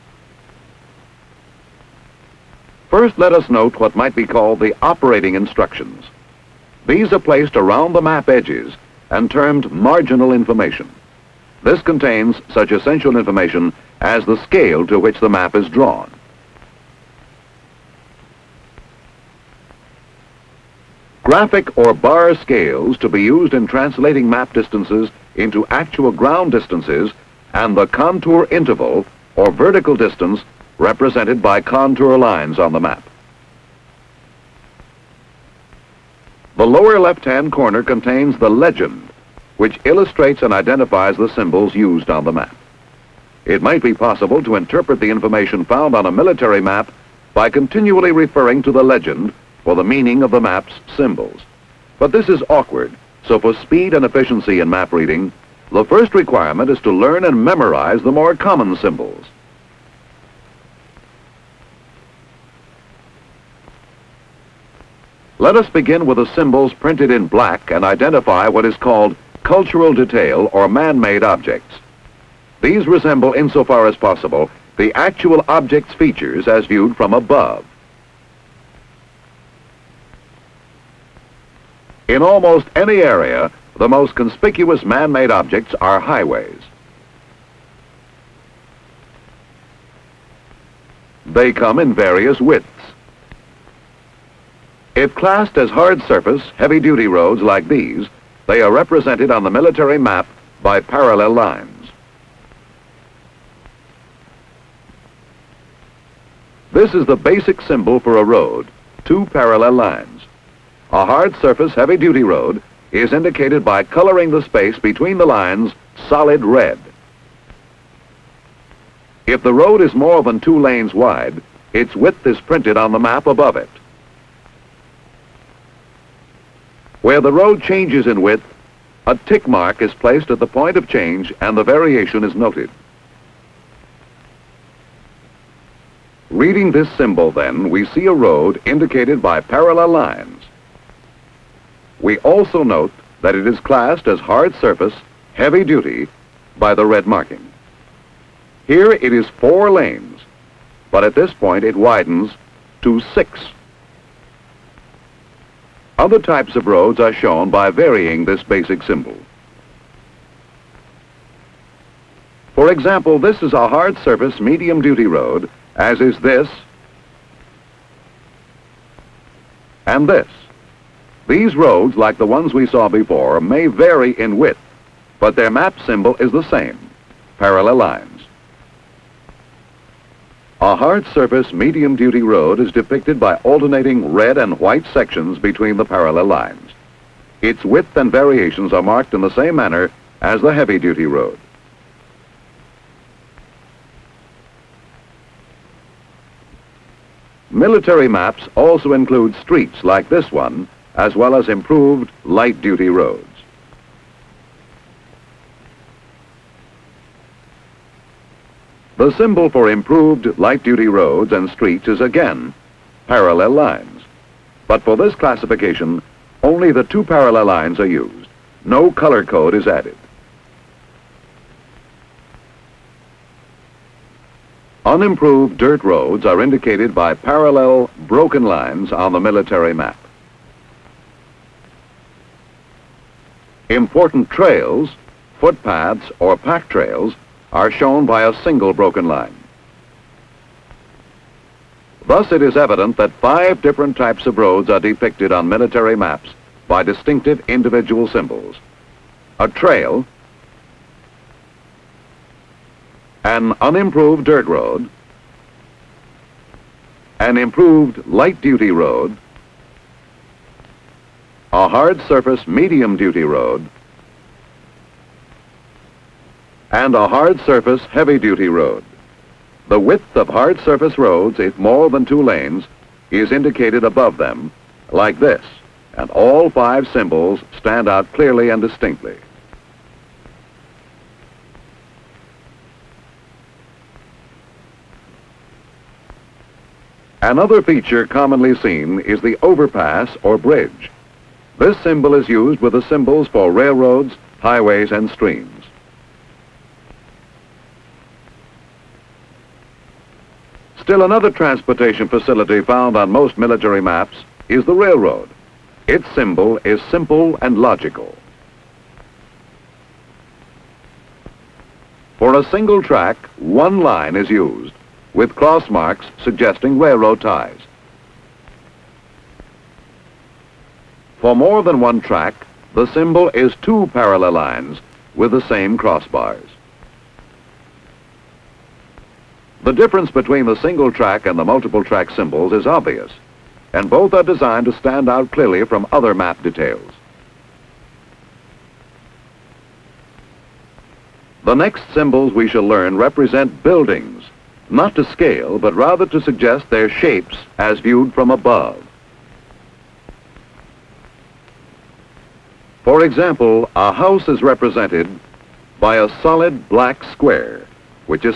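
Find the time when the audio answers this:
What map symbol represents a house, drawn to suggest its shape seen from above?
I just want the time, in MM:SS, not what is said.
05:56.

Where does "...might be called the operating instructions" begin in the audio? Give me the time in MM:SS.
00:03.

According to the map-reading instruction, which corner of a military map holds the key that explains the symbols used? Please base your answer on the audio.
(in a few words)
Lower left-hand corner.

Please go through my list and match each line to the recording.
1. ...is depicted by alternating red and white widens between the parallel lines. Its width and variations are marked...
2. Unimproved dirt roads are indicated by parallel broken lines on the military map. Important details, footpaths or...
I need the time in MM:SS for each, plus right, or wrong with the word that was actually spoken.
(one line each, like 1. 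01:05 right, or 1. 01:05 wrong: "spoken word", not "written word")
1. 03:02 wrong: "sections", not "widens"
2. 03:44 wrong: "trails", not "details".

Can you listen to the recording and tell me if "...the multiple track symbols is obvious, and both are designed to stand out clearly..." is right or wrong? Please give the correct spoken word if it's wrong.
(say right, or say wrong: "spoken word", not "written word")
right.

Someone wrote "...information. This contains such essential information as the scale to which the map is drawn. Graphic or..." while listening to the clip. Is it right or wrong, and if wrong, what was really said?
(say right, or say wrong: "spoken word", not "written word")
right.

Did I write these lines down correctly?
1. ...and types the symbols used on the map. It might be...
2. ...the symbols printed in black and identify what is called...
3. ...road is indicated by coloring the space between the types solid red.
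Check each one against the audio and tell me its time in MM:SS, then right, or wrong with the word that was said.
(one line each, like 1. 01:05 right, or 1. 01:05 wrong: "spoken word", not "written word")
1. 00:40 wrong: "identifies", not "types"
2. 01:06 right
3. 01:52 wrong: "lines", not "types".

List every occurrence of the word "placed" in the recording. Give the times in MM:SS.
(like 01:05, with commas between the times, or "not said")
00:07, 02:09.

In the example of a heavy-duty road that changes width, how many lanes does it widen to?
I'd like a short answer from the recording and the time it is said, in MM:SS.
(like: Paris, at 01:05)
6, at 02:33.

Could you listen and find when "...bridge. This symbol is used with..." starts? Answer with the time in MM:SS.
04:50.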